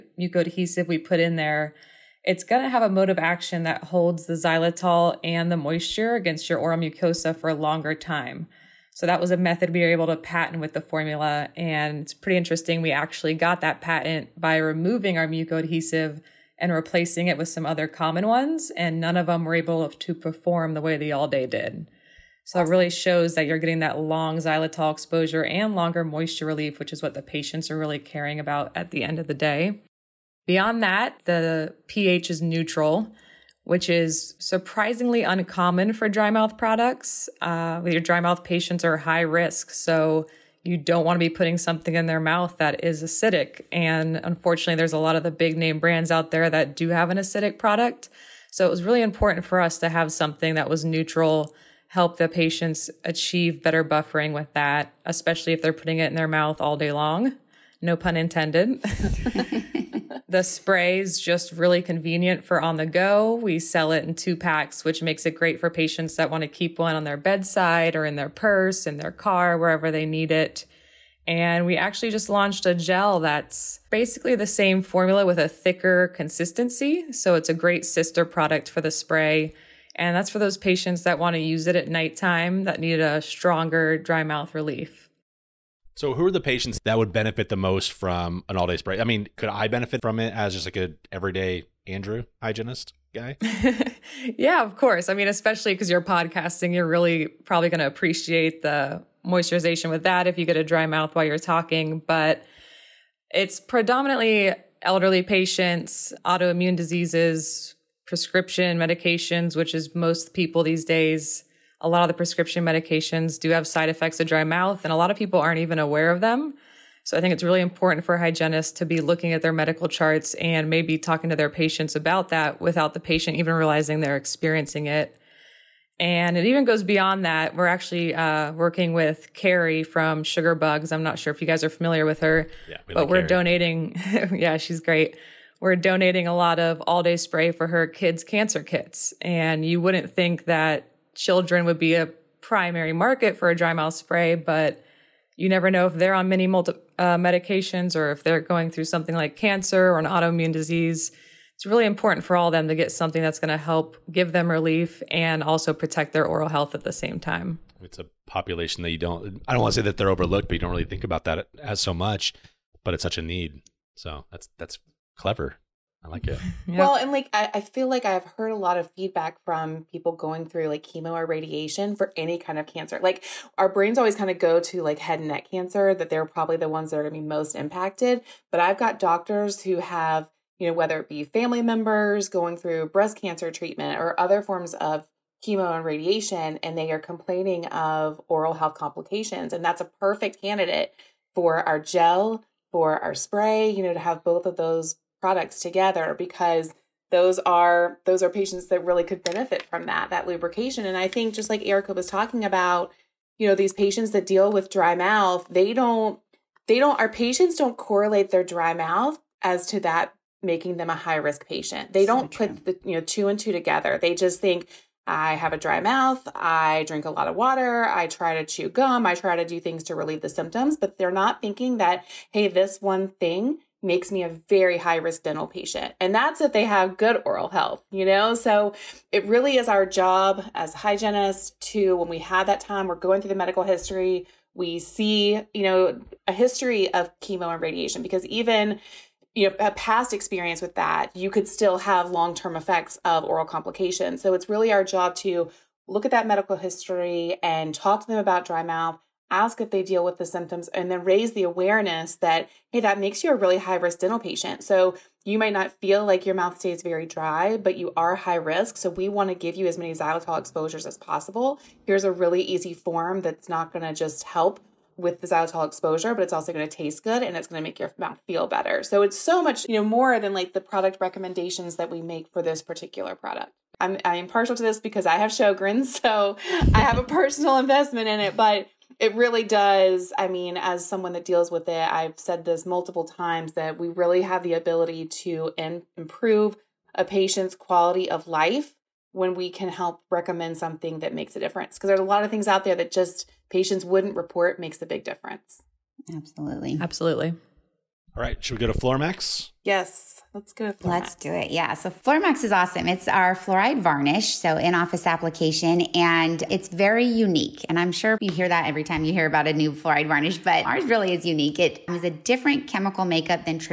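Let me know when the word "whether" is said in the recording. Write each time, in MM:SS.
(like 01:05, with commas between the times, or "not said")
03:00.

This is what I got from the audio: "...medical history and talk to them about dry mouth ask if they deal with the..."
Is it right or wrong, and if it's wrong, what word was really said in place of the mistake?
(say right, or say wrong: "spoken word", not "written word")
right.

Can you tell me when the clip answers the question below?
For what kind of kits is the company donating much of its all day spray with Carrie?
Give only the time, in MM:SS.
02:17.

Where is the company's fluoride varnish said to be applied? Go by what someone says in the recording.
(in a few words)
In office application.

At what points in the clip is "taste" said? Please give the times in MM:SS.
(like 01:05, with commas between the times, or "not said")
04:26.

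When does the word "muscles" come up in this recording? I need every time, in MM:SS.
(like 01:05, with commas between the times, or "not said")
not said.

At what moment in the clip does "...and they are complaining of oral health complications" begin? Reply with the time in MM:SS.
03:06.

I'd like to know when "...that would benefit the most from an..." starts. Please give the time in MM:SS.
01:26.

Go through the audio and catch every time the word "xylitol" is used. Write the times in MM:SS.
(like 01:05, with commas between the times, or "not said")
00:04, 00:24, 04:19, 04:25.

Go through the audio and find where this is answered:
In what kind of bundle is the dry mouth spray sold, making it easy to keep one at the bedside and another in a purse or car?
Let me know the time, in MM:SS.
01:04.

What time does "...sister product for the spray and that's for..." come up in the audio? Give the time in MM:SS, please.
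01:17.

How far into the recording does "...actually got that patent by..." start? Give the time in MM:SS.
00:12.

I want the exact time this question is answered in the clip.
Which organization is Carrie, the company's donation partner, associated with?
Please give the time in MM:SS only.
02:10.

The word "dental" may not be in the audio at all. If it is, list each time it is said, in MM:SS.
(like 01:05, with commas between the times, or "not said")
03:45, 04:14.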